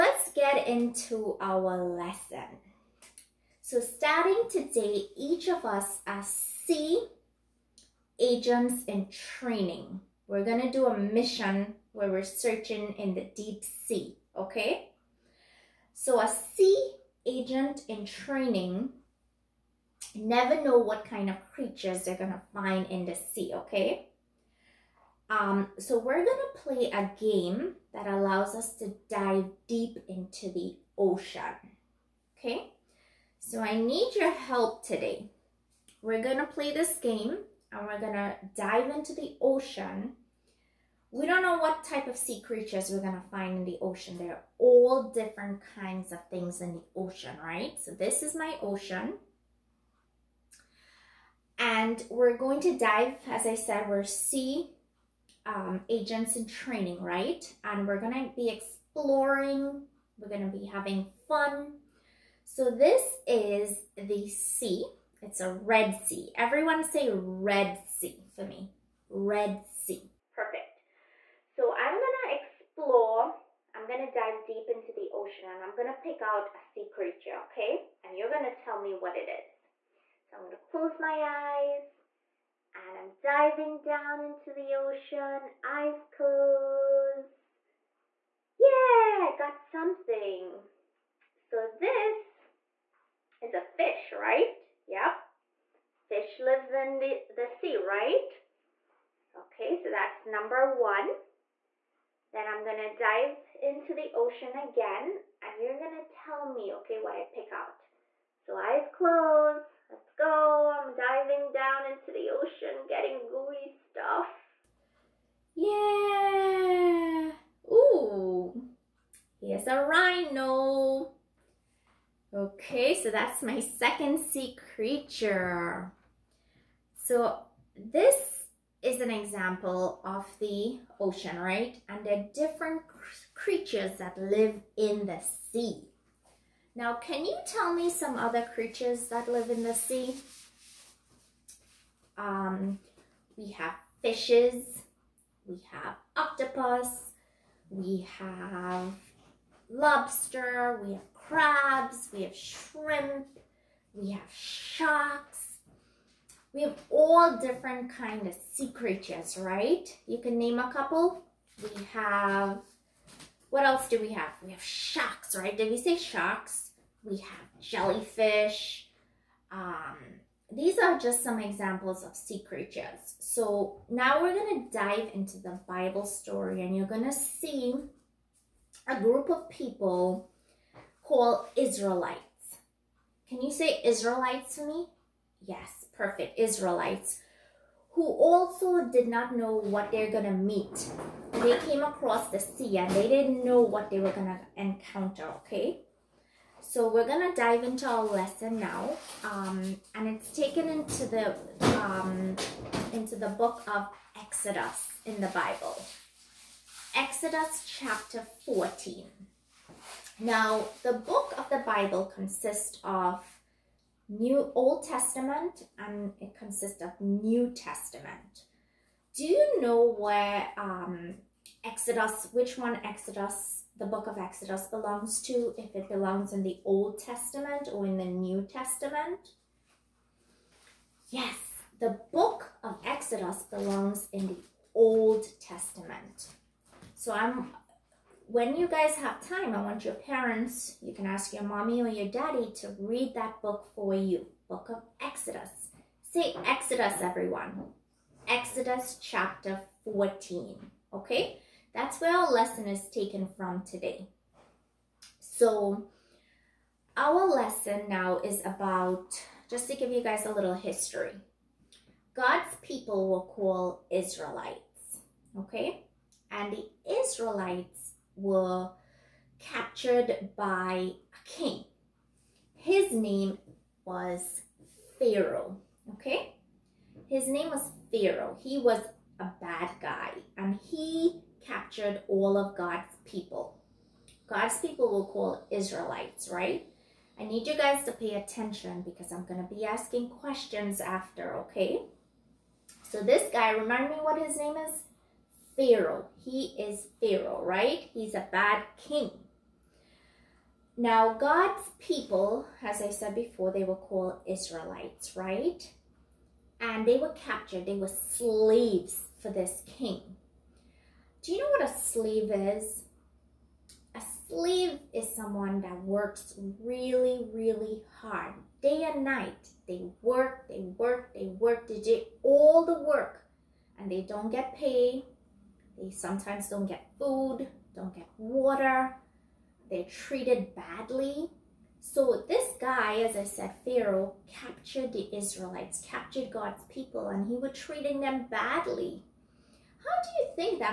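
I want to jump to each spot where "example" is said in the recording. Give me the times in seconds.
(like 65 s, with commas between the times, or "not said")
129 s, 171 s.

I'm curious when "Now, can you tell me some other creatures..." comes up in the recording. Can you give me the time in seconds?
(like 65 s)
136 s.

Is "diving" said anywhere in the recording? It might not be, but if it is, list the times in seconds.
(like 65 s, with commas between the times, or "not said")
83 s, 110 s.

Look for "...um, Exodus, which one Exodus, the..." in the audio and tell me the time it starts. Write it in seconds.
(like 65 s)
220 s.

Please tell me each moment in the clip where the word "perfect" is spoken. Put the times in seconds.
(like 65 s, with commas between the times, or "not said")
70 s, 185 s.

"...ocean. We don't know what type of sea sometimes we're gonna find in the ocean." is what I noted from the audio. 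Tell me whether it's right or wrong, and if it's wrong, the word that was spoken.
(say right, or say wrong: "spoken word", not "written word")
wrong: "creatures", not "sometimes".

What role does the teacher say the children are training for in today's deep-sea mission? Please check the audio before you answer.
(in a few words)
Sea agents.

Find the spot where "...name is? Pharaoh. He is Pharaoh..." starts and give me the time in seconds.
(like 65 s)
294 s.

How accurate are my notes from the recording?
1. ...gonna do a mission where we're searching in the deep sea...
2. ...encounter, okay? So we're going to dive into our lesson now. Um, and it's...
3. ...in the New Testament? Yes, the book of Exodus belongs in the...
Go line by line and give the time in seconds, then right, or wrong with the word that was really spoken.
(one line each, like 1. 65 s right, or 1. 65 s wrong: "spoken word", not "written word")
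1. 10 s right
2. 194 s right
3. 227 s right.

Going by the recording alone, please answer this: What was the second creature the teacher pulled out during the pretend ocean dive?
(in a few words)
Rhino.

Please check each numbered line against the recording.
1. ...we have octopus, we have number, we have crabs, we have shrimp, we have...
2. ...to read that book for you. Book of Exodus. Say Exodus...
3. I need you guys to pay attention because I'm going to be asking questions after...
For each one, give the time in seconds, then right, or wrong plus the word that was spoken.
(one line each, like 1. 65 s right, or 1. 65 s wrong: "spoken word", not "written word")
1. 145 s wrong: "lobster", not "number"
2. 242 s right
3. 287 s right.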